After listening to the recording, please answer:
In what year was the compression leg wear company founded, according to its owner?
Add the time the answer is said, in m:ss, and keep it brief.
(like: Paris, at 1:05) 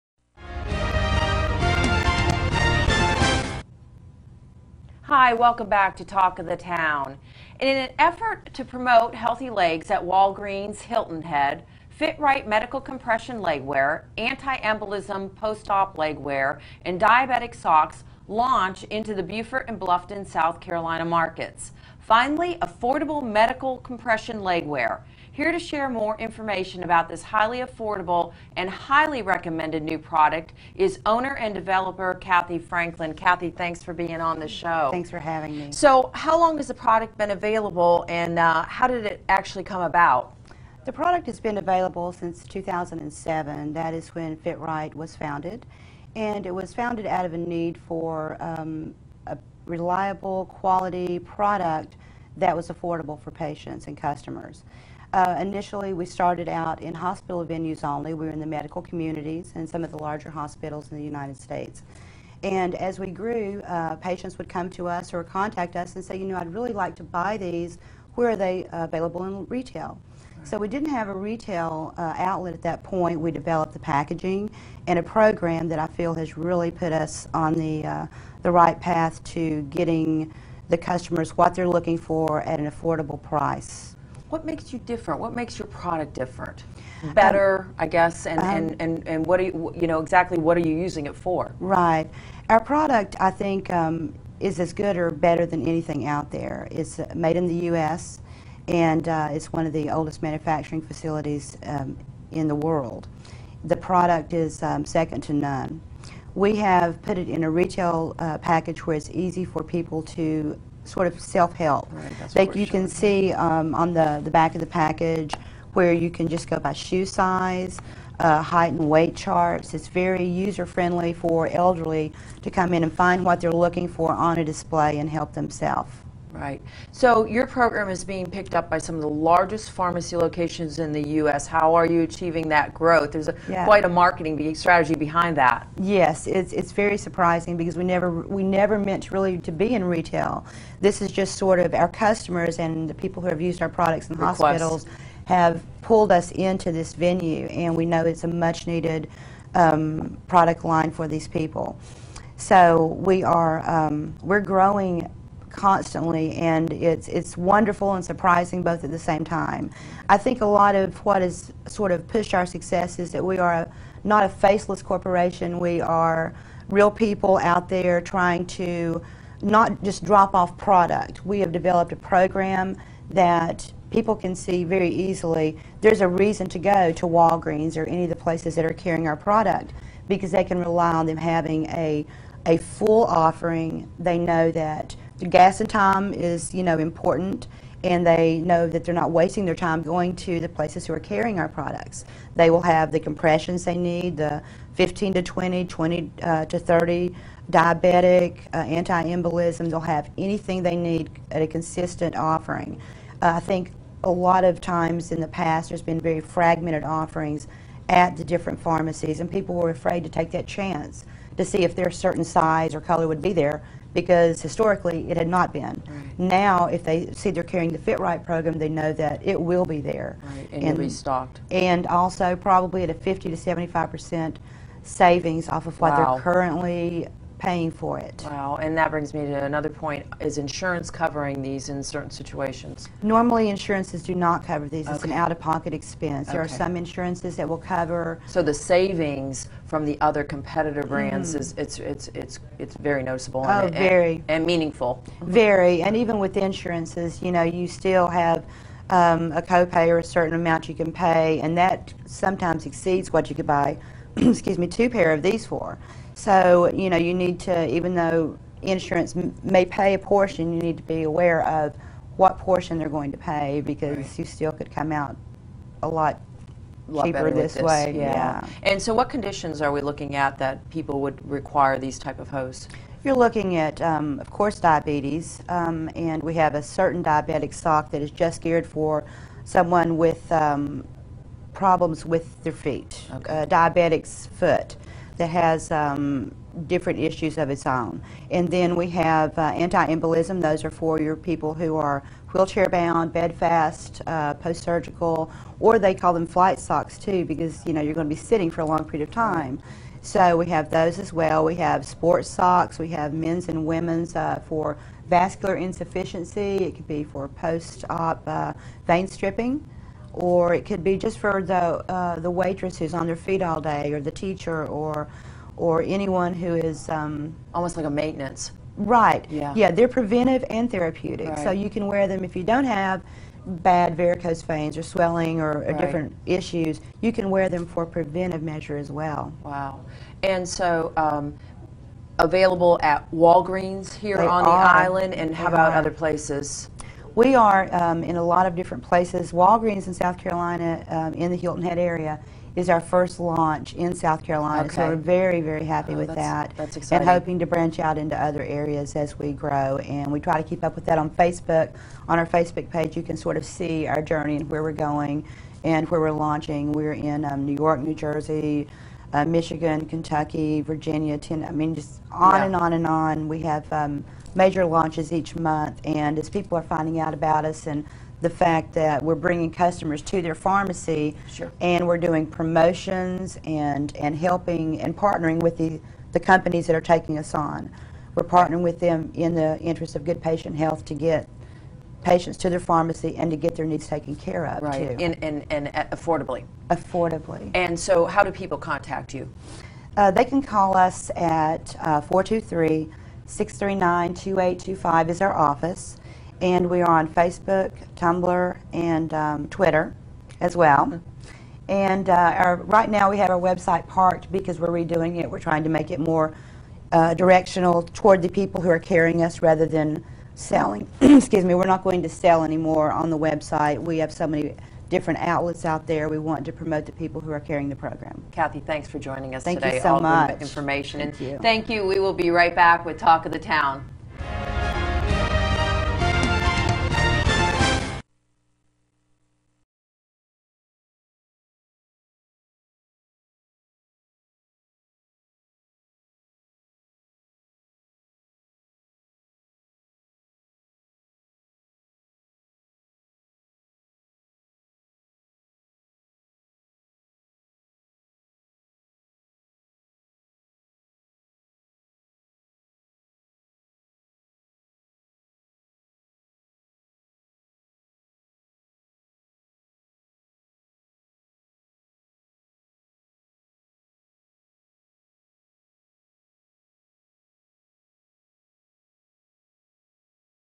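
2007, at 0:42.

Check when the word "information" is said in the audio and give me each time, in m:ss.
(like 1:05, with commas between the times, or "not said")
0:26, 7:00.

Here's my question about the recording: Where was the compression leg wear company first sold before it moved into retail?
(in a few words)
Hospital venues.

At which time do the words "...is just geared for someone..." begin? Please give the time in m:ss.
4:38.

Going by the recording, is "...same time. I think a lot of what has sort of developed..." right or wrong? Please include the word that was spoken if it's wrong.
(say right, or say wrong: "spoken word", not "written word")
wrong: "pushed", not "developed".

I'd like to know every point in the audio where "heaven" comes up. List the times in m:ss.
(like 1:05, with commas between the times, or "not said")
not said.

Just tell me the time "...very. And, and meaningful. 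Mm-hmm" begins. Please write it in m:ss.
4:03.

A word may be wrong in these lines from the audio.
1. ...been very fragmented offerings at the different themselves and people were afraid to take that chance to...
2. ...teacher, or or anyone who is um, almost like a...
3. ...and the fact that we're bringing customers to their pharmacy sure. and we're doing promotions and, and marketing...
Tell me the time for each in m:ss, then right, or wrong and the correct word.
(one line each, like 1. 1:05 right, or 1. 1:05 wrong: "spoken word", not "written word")
1. 3:25 wrong: "pharmacies", not "themselves"
2. 5:14 right
3. 6:07 wrong: "helping", not "marketing".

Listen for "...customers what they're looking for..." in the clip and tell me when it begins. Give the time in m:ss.
1:20.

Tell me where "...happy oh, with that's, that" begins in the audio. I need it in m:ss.
5:45.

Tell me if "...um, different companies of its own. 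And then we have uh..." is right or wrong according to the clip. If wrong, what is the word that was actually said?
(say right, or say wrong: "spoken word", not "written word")
wrong: "issues", not "companies".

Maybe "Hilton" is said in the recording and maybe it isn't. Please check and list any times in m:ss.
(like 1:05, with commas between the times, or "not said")
0:10, 5:41.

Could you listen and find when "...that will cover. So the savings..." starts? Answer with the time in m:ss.
3:57.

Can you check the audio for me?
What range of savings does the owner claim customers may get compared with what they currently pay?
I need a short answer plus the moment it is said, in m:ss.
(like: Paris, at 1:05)
50 to 75 percent, at 3:42.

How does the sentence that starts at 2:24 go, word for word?
hospitals have pulled us into this venue, and we know it's a much needed um, product line for these people.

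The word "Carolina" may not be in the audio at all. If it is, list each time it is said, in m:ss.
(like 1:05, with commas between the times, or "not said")
0:20, 5:40, 5:44.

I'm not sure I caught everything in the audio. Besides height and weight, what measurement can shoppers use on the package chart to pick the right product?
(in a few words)
Shoe size.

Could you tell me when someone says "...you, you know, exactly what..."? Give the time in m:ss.
1:29.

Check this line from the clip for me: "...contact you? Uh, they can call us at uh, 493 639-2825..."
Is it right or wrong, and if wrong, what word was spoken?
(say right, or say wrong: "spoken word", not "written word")
wrong: "423", not "493".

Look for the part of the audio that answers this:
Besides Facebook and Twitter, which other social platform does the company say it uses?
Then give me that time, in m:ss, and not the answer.
6:37.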